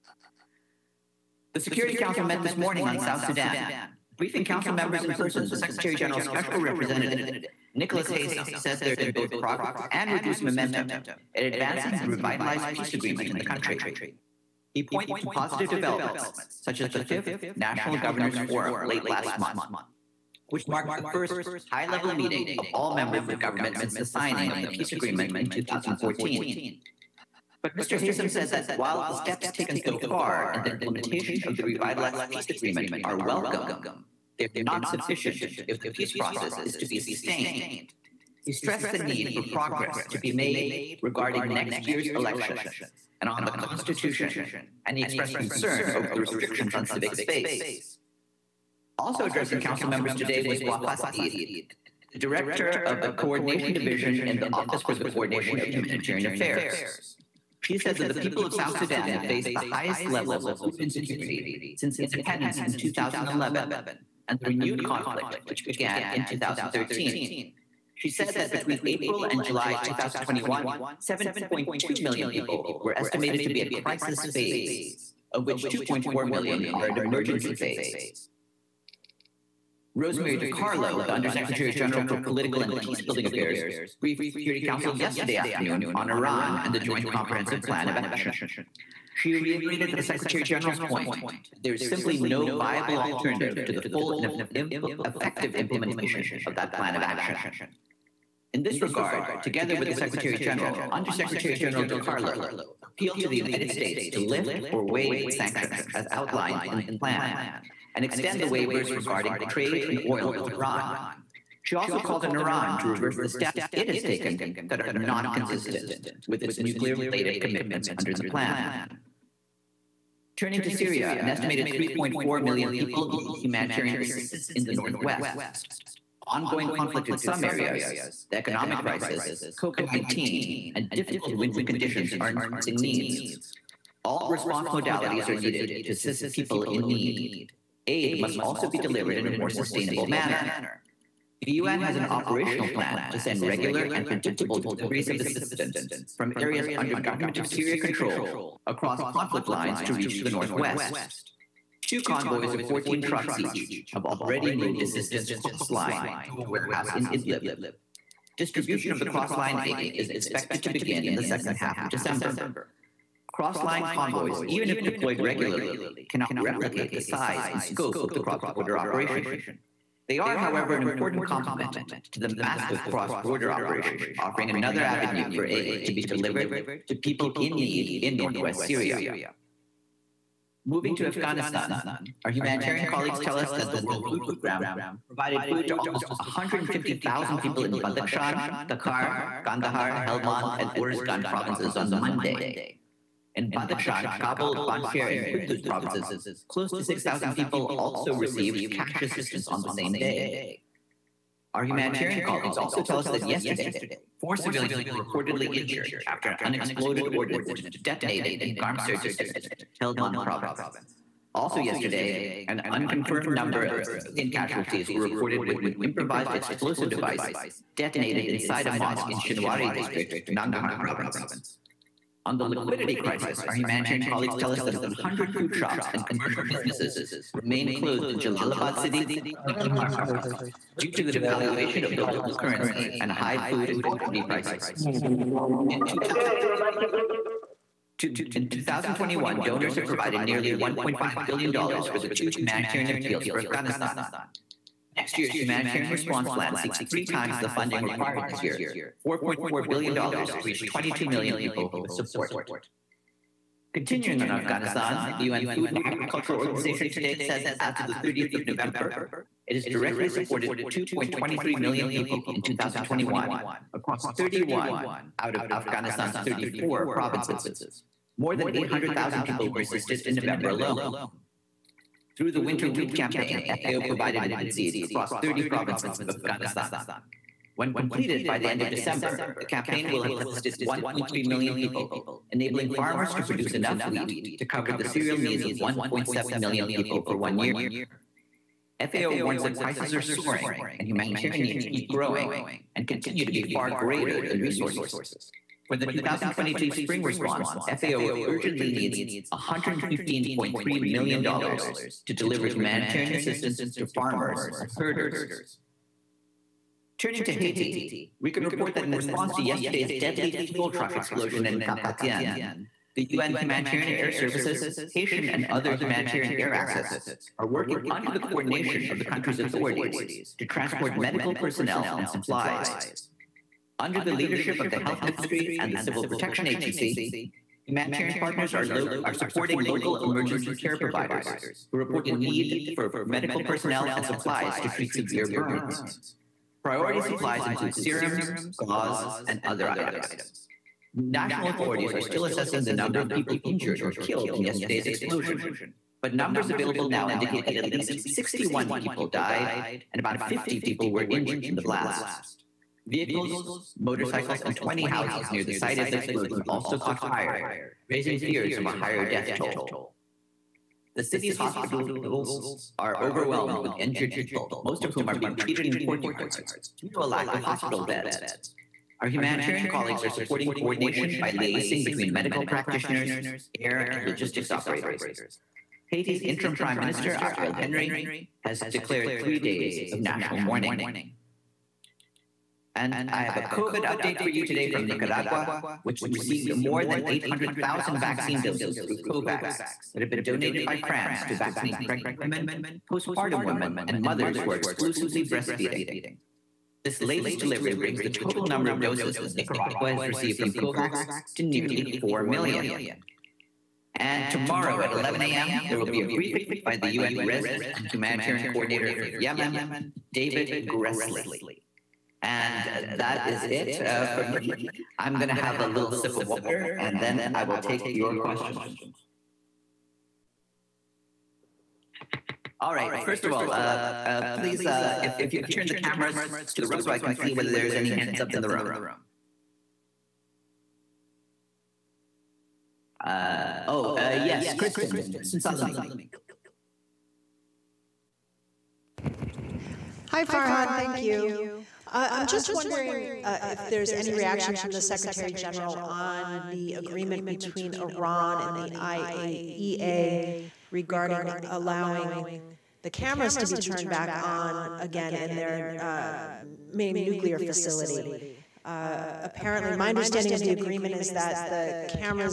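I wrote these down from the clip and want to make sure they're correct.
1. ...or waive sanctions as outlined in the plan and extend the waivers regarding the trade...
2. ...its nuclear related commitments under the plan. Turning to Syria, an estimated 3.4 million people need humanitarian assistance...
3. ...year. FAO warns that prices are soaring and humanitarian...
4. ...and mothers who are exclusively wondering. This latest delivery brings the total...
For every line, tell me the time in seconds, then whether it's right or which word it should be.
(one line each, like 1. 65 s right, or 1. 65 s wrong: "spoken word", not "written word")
1. 104 s right
2. 116 s right
3. 287 s right
4. 393 s wrong: "breastfeeding", not "wondering".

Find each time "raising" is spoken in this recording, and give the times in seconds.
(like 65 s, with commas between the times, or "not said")
357 s.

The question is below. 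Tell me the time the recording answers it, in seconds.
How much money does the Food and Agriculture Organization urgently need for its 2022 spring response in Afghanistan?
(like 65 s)
299 s.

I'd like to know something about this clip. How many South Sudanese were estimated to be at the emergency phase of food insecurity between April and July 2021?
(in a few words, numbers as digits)
2.4 million.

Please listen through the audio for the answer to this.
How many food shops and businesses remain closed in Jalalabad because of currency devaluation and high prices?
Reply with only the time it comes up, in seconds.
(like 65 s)
224 s.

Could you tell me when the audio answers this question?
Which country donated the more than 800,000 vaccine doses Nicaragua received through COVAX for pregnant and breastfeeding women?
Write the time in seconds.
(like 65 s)
390 s.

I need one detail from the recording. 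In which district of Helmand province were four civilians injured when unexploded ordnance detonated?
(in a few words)
Garmser.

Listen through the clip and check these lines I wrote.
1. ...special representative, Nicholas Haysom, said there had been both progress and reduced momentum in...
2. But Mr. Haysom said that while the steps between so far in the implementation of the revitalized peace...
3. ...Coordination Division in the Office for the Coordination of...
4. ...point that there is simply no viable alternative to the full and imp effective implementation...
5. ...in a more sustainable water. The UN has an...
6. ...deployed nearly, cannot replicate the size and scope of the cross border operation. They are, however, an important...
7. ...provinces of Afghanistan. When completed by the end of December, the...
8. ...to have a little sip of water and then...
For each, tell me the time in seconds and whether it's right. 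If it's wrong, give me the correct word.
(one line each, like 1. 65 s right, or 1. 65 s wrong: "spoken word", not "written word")
1. 6 s right
2. 27 s wrong: "taken", not "between"
3. 53 s right
4. 90 s right
5. 139 s wrong: "manner", not "water"
6. 164 s wrong: "regularly", not "nearly"
7. 275 s right
8. 415 s right.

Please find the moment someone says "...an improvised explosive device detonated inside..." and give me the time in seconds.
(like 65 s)
215 s.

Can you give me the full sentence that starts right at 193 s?
In Badakhshan, Kabul, Panjshir, and Kunduz provinces, close to 6,000 people also received cash assistance on the same day.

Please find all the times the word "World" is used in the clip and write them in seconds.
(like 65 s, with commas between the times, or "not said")
183 s.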